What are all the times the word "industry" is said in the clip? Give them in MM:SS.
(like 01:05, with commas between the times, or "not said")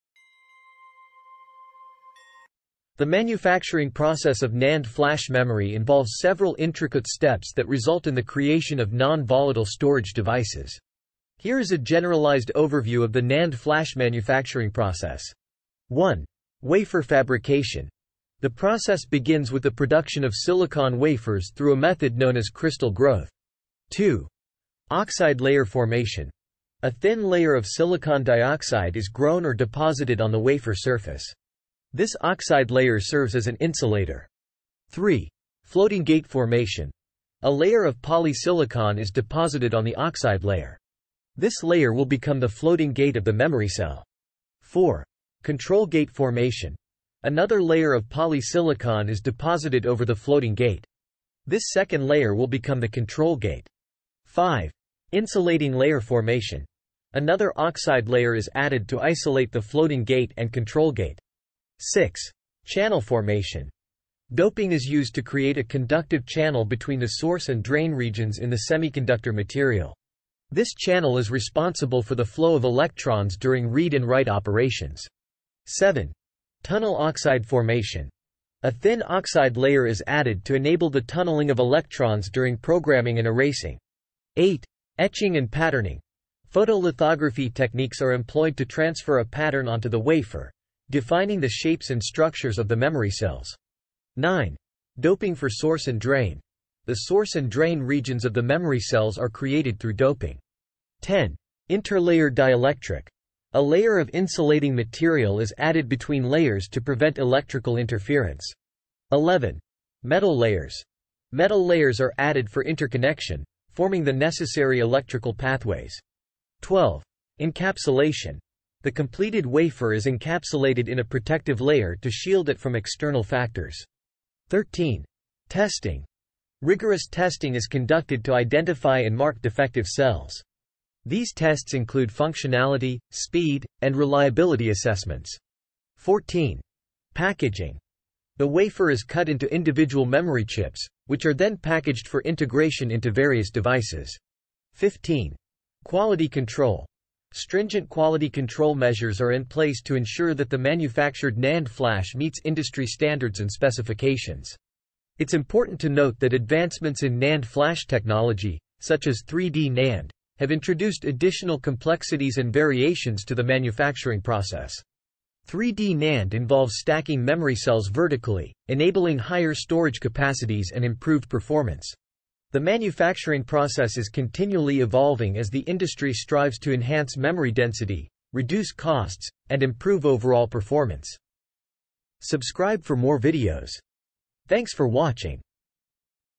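02:32, 02:55.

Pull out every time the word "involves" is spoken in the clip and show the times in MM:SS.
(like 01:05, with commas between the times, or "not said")
00:05, 02:46.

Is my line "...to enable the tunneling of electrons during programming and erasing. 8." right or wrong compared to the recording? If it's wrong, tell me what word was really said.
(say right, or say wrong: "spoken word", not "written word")
right.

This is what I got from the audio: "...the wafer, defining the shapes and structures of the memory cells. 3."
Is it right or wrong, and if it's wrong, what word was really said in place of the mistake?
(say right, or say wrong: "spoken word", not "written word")
wrong: "9", not "3".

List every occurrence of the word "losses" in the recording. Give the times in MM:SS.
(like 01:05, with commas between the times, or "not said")
not said.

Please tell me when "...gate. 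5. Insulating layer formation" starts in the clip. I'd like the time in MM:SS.
00:53.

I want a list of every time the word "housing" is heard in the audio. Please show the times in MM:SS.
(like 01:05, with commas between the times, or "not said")
not said.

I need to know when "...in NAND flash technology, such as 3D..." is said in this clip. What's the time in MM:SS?
02:37.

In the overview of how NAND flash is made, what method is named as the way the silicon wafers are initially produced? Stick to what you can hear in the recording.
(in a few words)
crystal growth.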